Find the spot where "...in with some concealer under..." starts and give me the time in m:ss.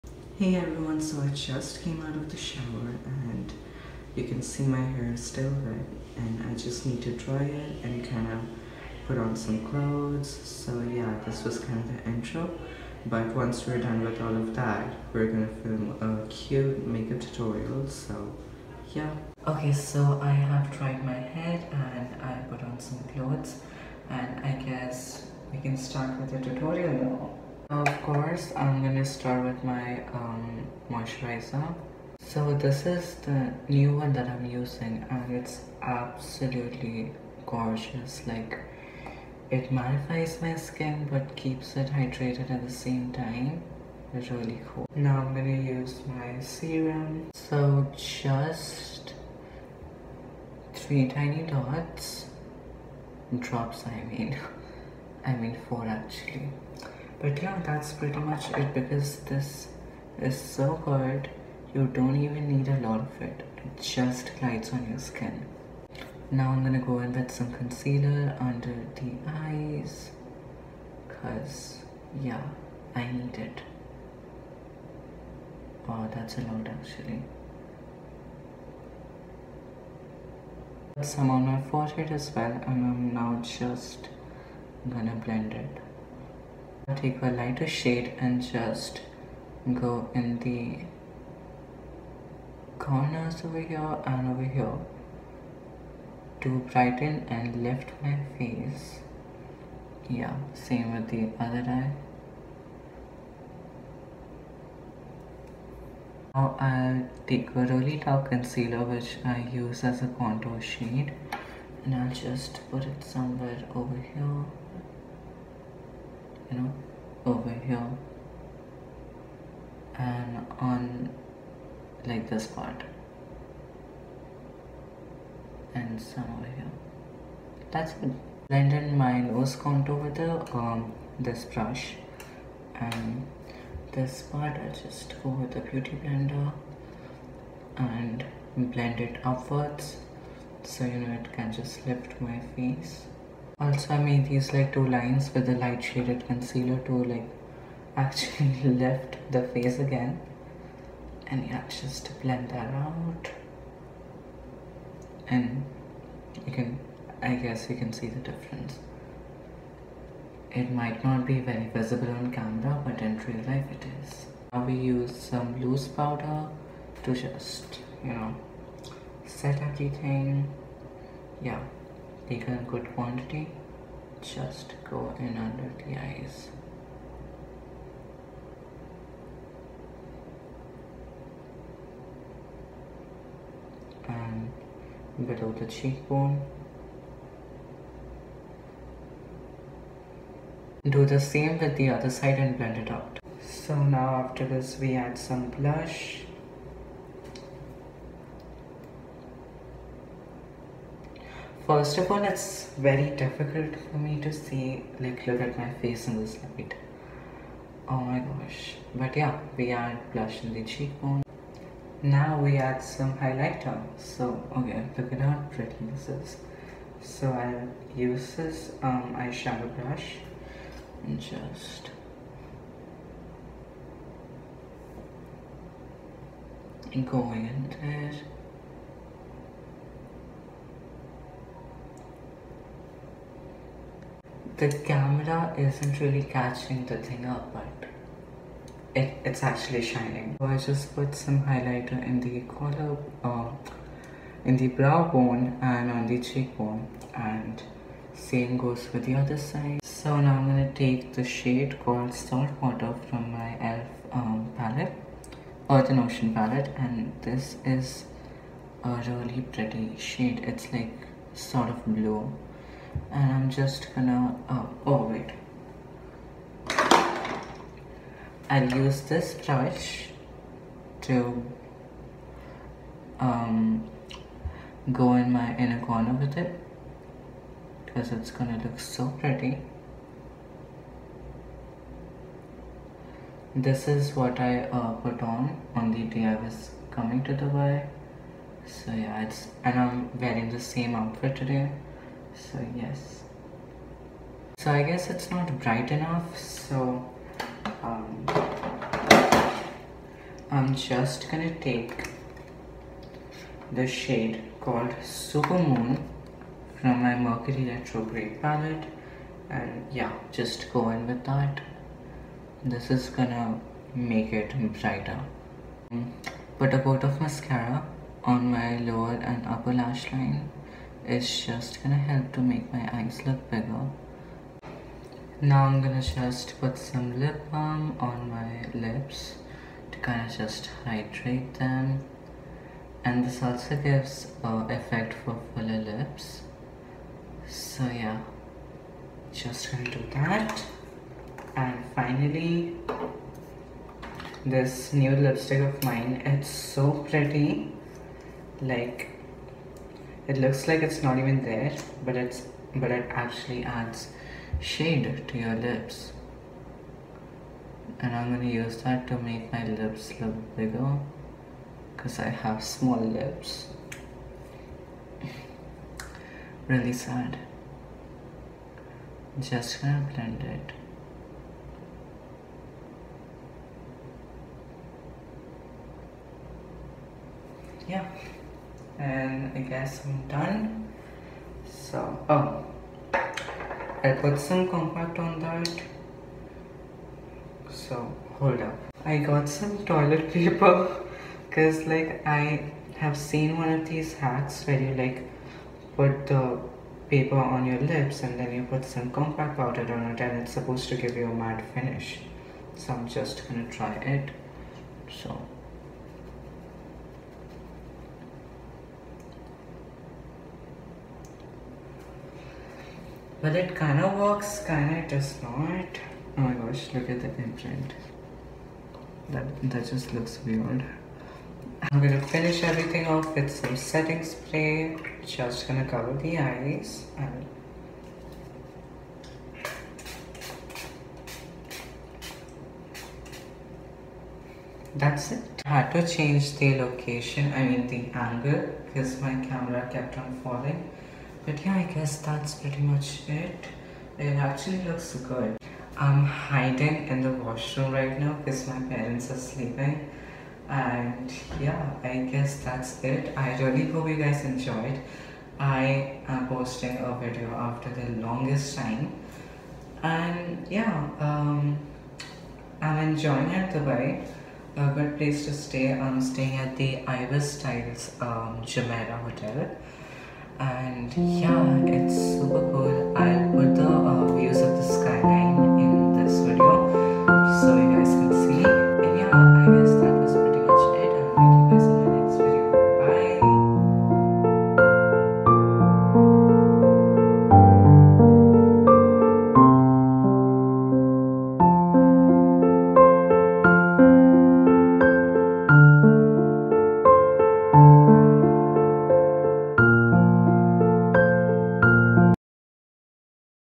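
1:06.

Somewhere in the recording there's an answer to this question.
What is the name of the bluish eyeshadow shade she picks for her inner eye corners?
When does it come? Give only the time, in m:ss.
4:12.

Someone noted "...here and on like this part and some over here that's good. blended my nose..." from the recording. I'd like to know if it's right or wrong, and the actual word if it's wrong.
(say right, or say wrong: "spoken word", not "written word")
right.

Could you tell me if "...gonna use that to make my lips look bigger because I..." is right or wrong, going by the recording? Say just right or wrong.
right.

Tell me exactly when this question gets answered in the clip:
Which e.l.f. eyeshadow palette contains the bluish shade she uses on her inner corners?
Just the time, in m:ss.
4:15.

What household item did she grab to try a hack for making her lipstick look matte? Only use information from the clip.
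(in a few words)
toilet paper.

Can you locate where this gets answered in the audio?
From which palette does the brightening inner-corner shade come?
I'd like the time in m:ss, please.
5:07.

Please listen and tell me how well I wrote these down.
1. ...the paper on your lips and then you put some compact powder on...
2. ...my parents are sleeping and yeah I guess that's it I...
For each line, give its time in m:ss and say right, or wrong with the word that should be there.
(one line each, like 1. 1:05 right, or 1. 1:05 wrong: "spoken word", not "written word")
1. 6:36 right
2. 7:28 right.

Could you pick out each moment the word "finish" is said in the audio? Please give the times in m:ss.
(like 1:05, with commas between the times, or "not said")
6:41, 7:02.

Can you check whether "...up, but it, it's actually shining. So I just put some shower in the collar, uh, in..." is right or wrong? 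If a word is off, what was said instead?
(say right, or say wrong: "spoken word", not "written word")
wrong: "highlighter", not "shower".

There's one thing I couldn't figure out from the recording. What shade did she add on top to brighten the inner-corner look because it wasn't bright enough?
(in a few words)
Supermoon.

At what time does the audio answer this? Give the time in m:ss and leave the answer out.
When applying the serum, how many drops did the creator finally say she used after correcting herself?
0:55.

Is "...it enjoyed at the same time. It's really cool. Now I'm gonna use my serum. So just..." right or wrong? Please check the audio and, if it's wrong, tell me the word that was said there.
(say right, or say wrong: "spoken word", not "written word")
wrong: "hydrated", not "enjoyed".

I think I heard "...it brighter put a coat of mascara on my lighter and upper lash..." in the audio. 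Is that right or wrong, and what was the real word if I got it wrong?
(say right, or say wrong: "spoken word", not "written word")
wrong: "lower", not "lighter".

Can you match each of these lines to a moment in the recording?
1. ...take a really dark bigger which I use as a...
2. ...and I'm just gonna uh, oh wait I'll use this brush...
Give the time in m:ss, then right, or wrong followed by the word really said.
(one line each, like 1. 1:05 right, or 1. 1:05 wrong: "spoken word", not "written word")
1. 1:47 wrong: "concealer", not "bigger"
2. 4:23 right.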